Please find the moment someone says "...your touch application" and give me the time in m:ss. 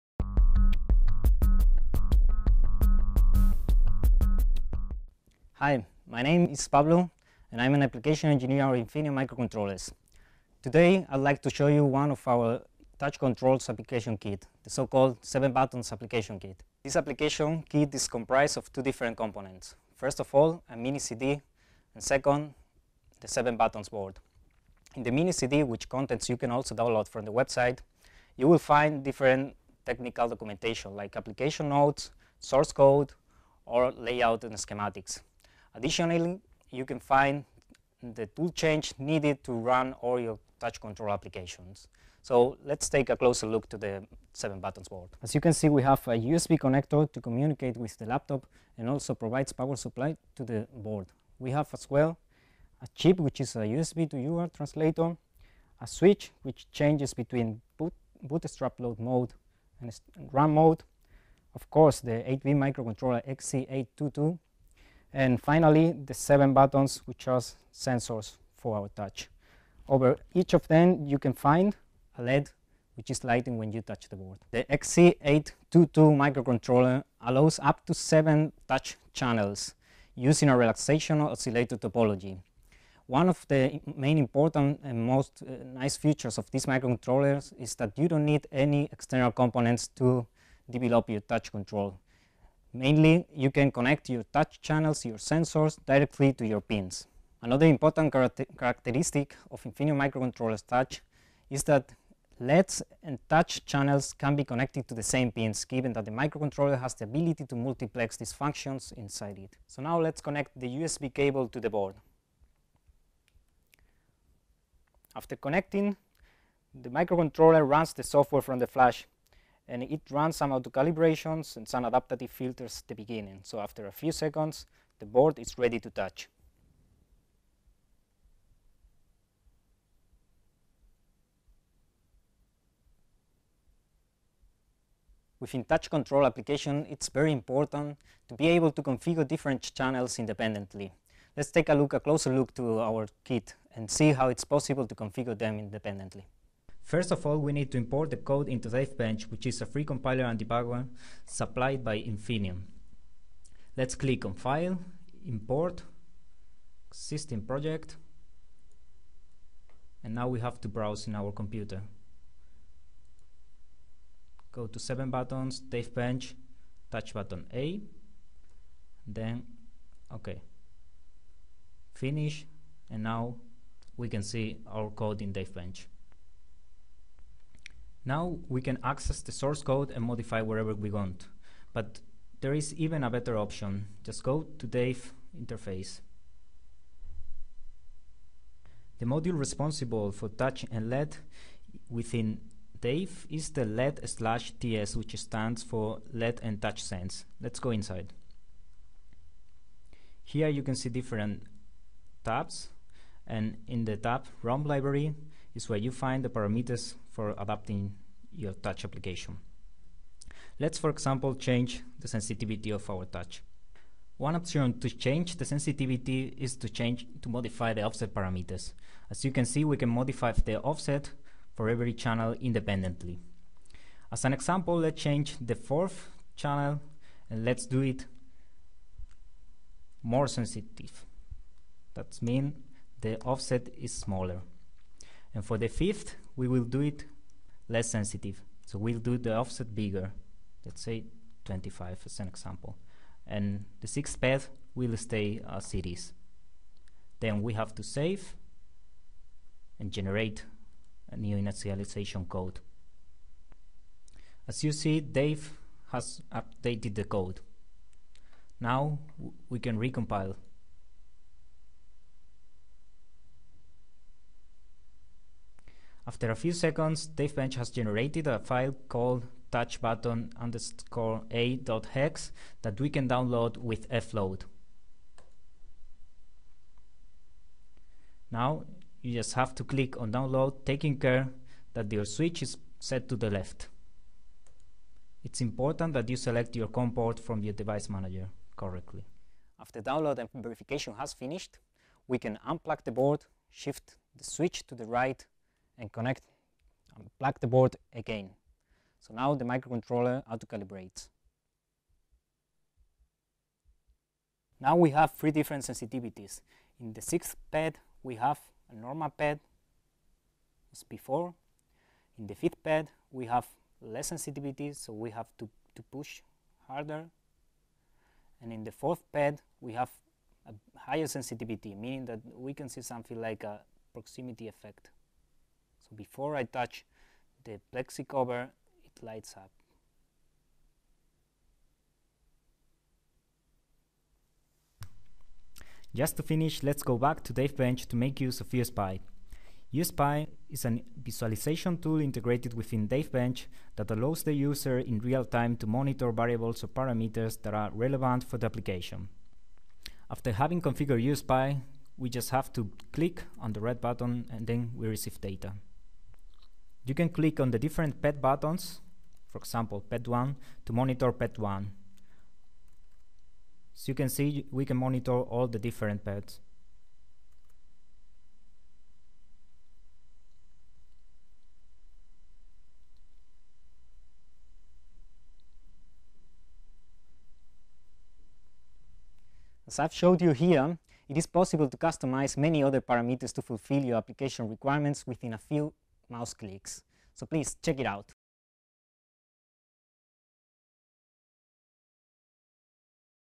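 3:28.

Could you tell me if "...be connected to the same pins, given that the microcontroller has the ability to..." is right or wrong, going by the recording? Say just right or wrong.
right.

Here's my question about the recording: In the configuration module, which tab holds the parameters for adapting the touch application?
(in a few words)
ROM library.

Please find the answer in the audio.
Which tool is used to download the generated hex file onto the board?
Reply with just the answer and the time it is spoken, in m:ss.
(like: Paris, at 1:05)
Fload, at 4:33.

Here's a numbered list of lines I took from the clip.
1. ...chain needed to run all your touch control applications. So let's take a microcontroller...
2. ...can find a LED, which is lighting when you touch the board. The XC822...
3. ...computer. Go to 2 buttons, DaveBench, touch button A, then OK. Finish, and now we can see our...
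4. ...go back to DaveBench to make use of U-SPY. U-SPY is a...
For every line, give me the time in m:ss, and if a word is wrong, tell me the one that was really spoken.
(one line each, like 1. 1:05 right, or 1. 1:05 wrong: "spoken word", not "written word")
1. 0:38 wrong: "closer", not "microcontroller"
2. 1:11 right
3. 2:41 wrong: "7", not "2"
4. 5:36 right.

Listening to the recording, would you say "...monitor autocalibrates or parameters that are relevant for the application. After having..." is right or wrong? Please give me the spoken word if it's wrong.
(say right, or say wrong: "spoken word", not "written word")
wrong: "variables", not "autocalibrates".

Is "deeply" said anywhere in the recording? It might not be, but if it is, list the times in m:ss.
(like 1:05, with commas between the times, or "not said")
not said.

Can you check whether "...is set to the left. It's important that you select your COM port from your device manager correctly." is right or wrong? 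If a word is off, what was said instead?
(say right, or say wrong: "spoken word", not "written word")
right.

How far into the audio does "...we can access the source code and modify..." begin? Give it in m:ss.
2:58.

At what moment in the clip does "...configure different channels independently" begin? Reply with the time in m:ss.
2:18.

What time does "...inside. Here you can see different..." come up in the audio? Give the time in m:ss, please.
3:17.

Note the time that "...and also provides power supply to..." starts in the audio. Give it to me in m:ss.
0:48.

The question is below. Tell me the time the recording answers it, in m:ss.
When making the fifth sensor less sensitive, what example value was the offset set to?
4:01.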